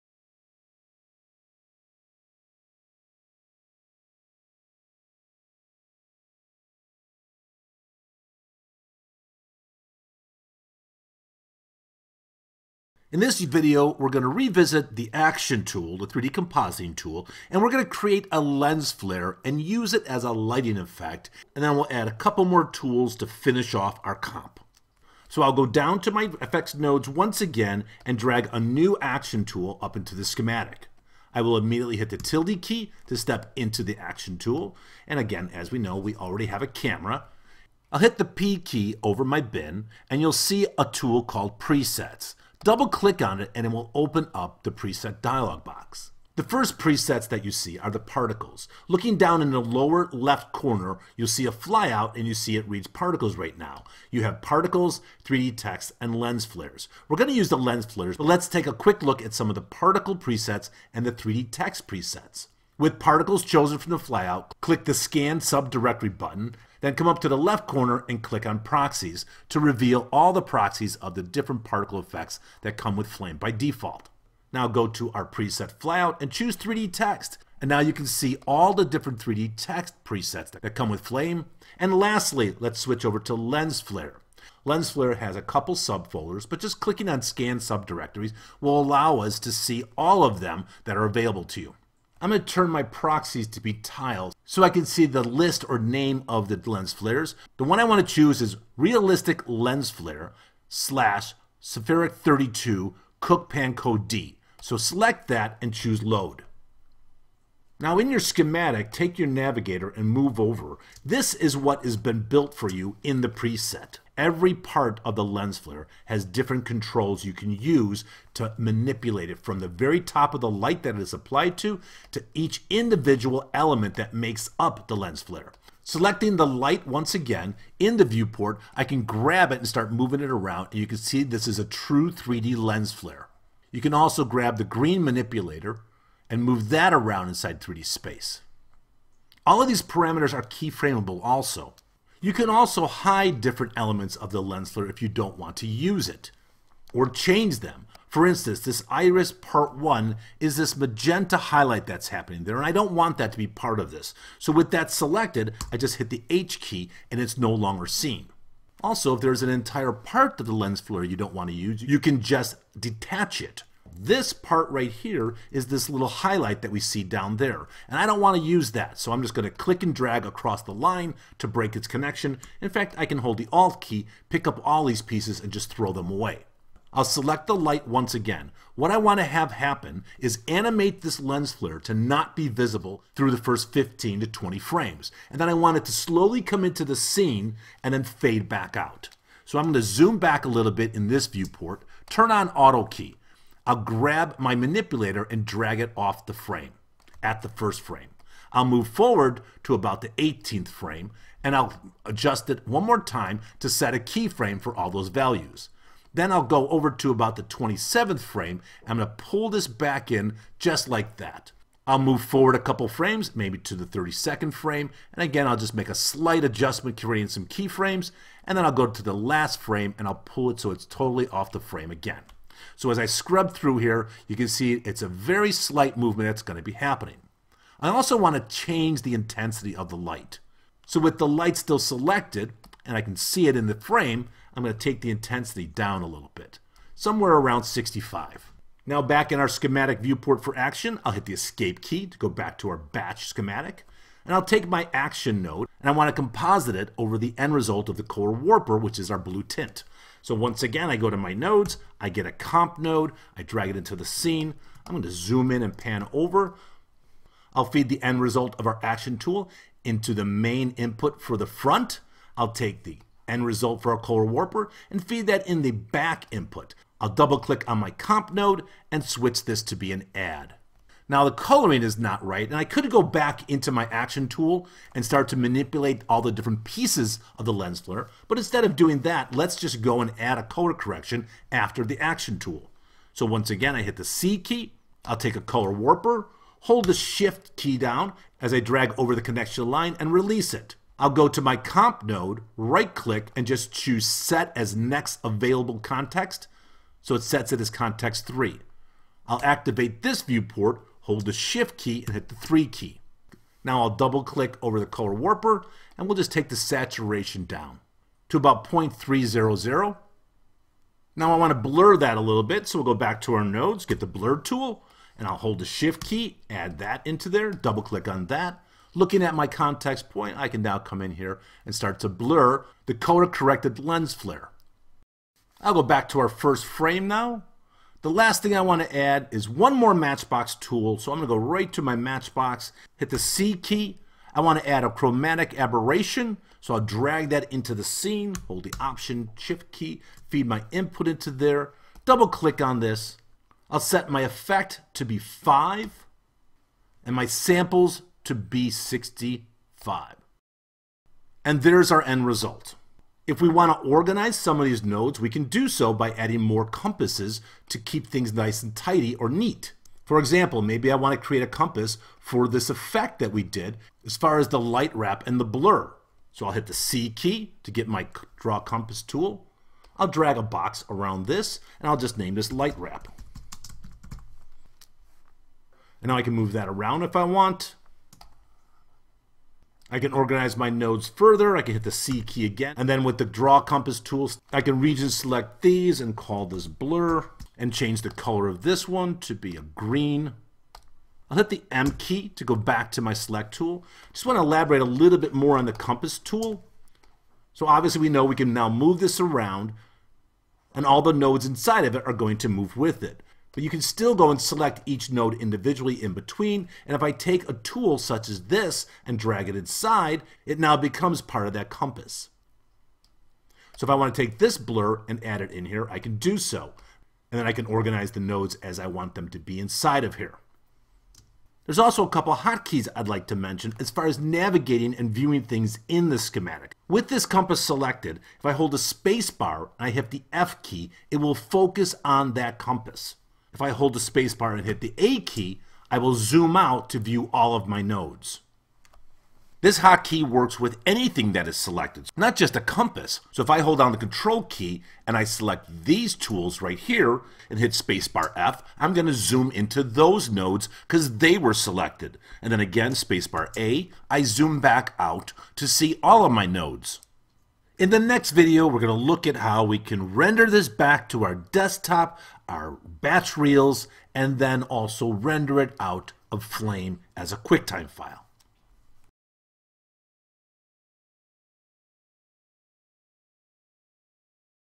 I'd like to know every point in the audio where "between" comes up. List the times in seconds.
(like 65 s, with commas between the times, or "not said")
406 s.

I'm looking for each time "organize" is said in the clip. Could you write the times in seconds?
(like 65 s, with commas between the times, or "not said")
353 s, 380 s, 417 s.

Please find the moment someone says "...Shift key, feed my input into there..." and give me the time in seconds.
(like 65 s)
339 s.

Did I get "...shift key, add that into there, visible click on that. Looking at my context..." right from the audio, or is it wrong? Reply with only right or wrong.
wrong.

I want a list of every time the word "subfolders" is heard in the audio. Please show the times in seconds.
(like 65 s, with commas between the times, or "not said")
85 s.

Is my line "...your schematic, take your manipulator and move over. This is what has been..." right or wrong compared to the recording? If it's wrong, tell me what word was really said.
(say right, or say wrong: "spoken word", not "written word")
wrong: "navigator", not "manipulator".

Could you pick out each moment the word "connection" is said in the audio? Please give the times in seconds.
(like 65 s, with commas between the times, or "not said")
171 s, 289 s.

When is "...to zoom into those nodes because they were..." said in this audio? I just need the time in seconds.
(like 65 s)
449 s.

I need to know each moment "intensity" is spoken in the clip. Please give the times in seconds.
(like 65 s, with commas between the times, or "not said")
229 s, 235 s.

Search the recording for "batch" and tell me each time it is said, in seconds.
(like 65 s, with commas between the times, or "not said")
242 s, 462 s.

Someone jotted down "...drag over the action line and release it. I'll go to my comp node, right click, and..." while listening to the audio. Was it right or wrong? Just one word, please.
wrong.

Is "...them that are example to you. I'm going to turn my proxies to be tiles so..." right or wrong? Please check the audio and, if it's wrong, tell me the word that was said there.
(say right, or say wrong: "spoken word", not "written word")
wrong: "available", not "example".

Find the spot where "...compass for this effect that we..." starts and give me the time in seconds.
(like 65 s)
361 s.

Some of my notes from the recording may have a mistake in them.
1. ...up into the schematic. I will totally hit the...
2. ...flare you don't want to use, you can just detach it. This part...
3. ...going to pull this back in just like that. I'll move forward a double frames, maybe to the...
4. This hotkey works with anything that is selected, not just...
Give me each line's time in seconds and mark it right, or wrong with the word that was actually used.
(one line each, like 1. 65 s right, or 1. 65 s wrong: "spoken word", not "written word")
1. 29 s wrong: "immediately", not "totally"
2. 160 s right
3. 208 s wrong: "couple", not "double"
4. 439 s right.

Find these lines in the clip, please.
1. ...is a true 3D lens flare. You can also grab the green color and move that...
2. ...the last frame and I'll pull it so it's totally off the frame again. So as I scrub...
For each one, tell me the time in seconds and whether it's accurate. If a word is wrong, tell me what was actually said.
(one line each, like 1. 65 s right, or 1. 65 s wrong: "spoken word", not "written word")
1. 131 s wrong: "manipulator", not "color"
2. 219 s right.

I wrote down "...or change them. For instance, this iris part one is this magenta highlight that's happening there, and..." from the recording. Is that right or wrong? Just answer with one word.
right.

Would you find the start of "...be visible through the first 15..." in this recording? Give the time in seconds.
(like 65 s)
182 s.